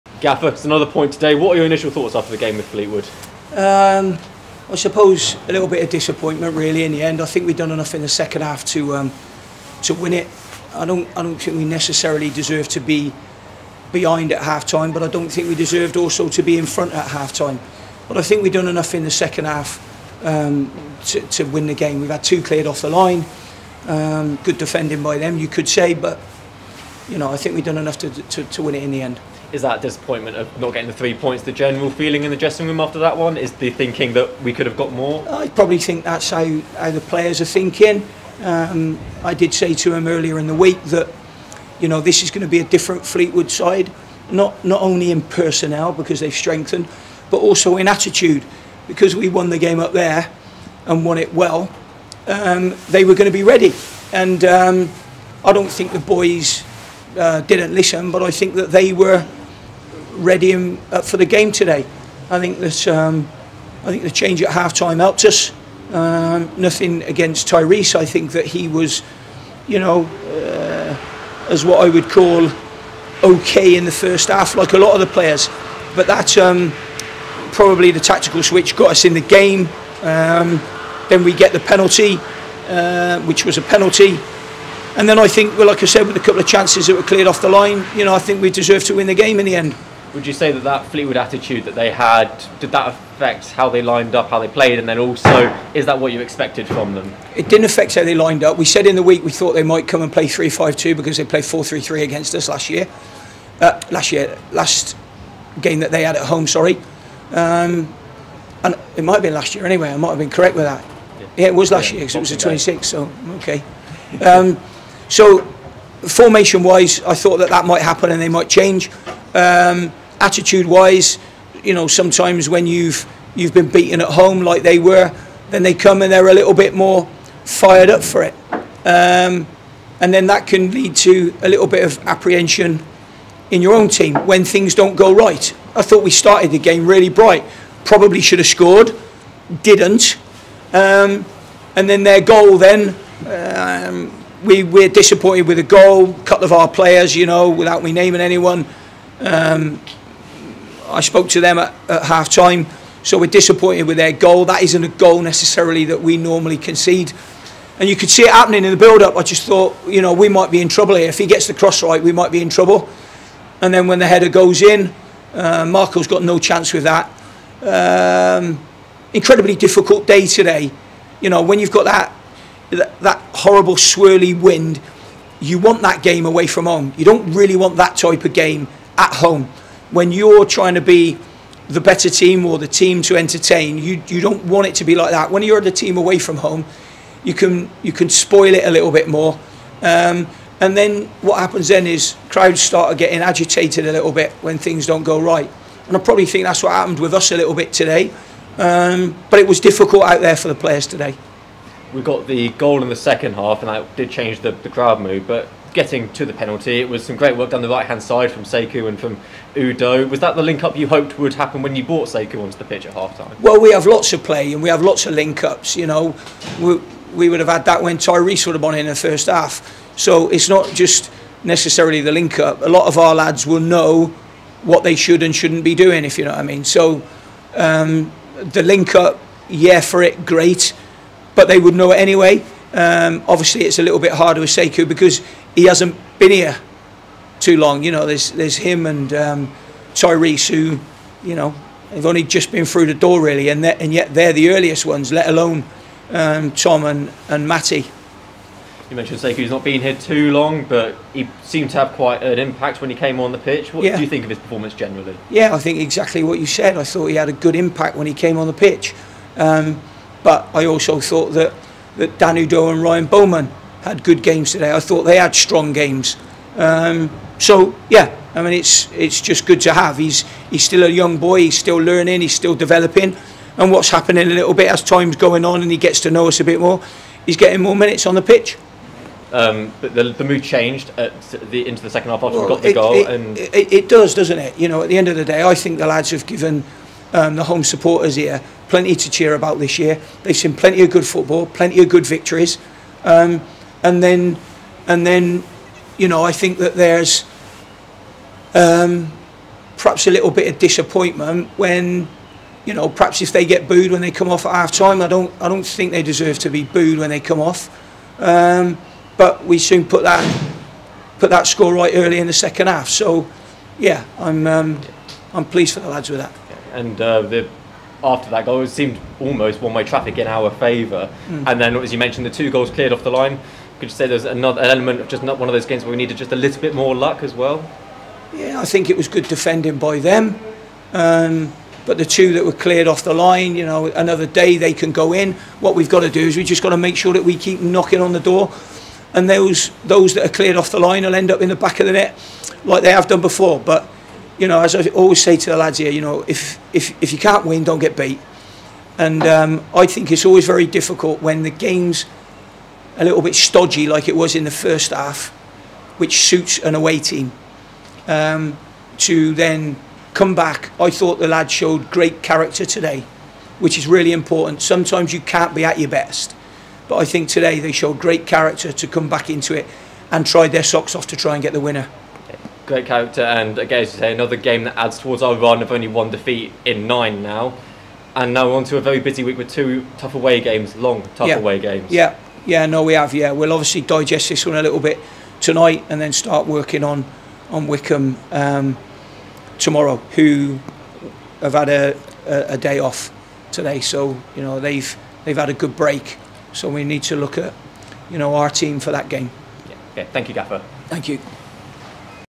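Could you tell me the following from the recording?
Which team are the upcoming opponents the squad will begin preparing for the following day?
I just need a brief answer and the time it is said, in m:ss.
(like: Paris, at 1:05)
Wycombe, at 6:27.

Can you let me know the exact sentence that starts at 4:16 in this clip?
I thought he had a good impact when he came on the pitch.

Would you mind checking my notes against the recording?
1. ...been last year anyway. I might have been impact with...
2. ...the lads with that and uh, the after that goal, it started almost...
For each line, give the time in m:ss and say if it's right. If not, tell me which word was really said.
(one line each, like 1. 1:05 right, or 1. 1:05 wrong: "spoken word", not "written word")
1. 1:49 wrong: "correct", not "impact"
2. 5:15 wrong: "seemed", not "started".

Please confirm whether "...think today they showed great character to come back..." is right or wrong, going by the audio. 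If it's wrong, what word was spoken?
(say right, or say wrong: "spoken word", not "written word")
right.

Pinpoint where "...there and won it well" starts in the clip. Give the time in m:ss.
0:49.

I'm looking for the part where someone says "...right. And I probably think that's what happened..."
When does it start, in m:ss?
3:15.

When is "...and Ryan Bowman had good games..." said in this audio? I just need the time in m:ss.
4:22.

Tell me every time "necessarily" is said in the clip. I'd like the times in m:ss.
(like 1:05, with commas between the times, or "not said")
0:11, 2:35, 3:41.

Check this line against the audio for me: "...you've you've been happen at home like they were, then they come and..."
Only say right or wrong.
wrong.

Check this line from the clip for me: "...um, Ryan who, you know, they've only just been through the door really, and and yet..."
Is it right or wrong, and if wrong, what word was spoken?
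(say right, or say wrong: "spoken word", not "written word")
wrong: "Tyrese", not "Ryan".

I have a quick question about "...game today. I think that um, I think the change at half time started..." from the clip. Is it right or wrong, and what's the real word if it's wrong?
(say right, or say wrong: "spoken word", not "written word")
wrong: "helped", not "started".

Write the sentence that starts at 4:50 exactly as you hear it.
They've seen plenty of good football, plenty of good victories.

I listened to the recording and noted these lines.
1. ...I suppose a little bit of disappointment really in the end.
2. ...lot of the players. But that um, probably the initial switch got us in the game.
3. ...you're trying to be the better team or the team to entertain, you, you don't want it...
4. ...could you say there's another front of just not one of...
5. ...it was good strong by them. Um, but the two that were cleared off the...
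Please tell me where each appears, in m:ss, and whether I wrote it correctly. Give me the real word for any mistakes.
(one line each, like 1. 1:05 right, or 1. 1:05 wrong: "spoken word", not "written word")
1. 0:04 right
2. 1:14 wrong: "tactical", not "initial"
3. 3:00 right
4. 5:23 wrong: "element", not "front"
5. 5:28 wrong: "defending", not "strong".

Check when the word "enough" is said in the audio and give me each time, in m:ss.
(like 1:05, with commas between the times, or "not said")
0:07, 0:18, 0:27.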